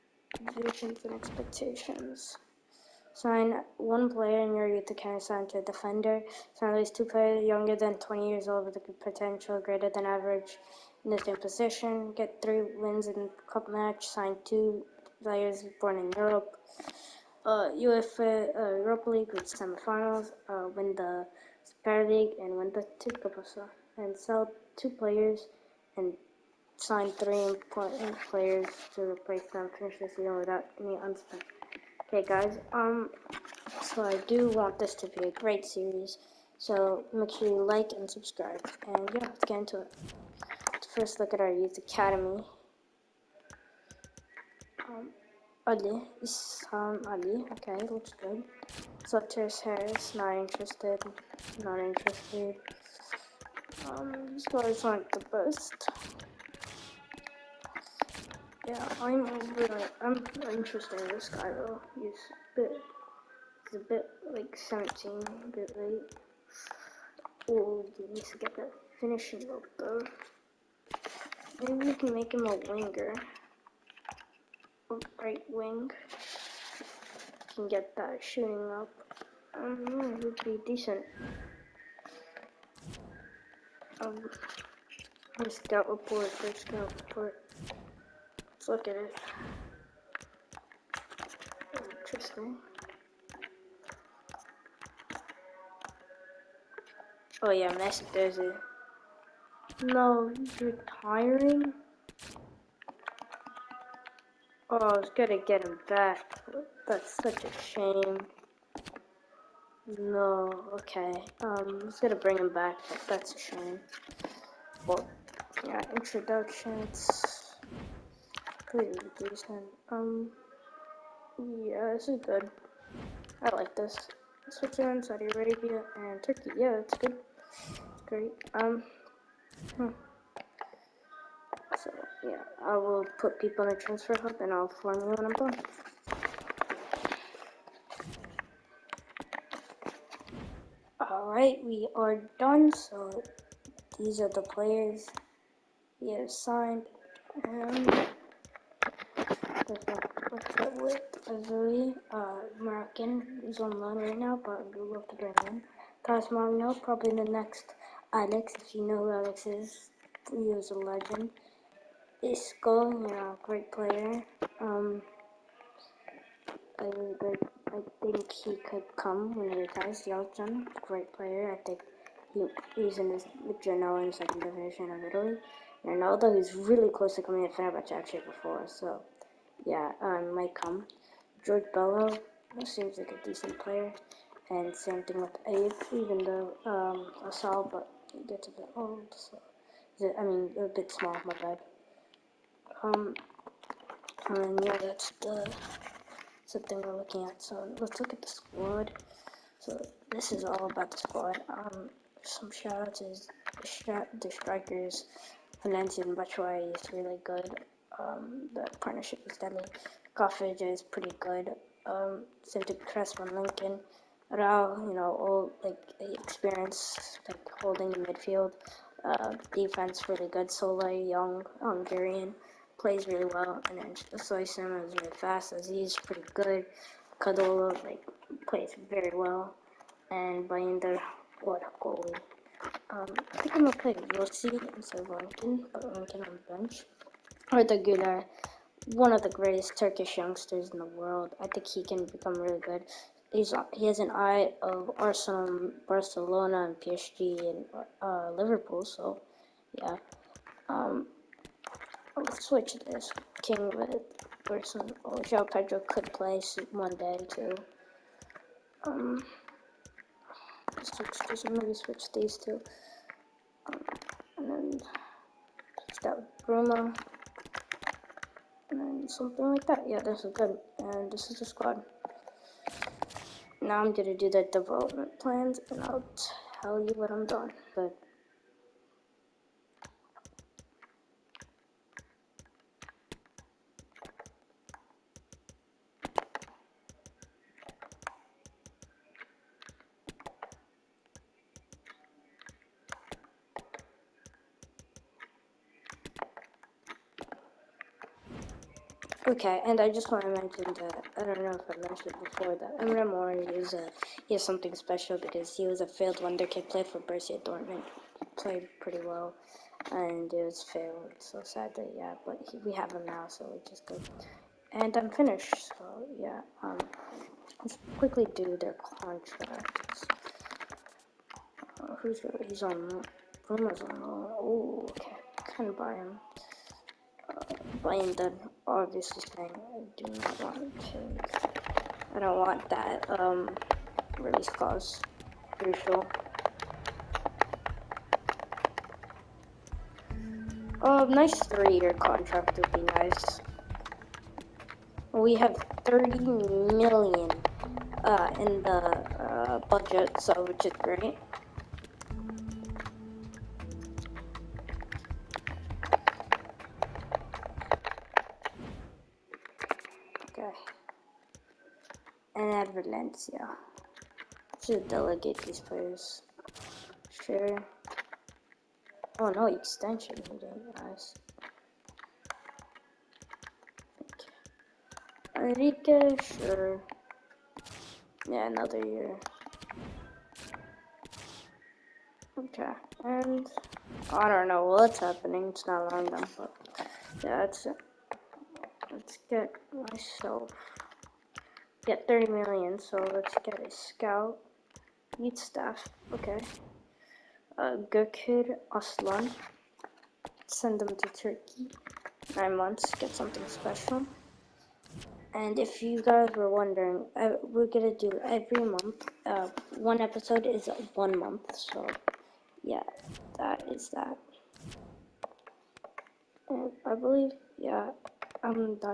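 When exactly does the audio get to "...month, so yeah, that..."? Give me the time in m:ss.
6:51.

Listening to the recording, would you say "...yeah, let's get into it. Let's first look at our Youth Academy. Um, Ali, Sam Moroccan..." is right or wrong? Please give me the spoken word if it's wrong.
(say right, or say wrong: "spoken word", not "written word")
wrong: "Ali", not "Moroccan".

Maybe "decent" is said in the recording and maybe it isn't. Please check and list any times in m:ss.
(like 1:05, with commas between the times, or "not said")
1:20, 1:59, 3:03.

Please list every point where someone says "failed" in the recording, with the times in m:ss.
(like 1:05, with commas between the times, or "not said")
5:05, 5:10.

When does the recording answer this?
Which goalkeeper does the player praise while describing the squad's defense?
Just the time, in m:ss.
3:50.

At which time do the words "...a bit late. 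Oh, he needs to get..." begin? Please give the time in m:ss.
1:05.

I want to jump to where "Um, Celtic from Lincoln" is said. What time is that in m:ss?
3:31.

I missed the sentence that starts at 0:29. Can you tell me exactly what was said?
Finish the season without any unspent.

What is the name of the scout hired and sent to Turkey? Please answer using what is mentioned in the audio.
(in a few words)
Gökhan Aslan.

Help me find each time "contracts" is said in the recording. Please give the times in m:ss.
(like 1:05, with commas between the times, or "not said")
5:19, 5:41.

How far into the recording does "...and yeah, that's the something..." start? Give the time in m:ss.
3:14.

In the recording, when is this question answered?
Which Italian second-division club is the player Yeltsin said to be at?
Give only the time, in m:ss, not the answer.
2:53.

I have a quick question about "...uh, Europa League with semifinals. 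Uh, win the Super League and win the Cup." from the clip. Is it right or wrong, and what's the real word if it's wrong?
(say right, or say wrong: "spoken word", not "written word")
right.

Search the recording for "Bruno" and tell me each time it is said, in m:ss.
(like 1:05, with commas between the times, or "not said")
4:26, 5:23.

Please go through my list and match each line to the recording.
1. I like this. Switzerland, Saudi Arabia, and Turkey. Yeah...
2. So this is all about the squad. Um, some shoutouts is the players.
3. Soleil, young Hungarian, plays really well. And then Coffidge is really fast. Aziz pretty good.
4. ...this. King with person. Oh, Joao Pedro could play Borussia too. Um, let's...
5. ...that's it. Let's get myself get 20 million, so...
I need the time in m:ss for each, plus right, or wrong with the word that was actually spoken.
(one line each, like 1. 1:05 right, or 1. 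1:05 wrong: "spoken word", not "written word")
1. 2:03 right
2. 3:19 wrong: "strikers", not "players"
3. 3:40 wrong: "Soysim", not "Coffidge"
4. 4:12 wrong: "Monday", not "Borussia"
5. 6:27 wrong: "30", not "20".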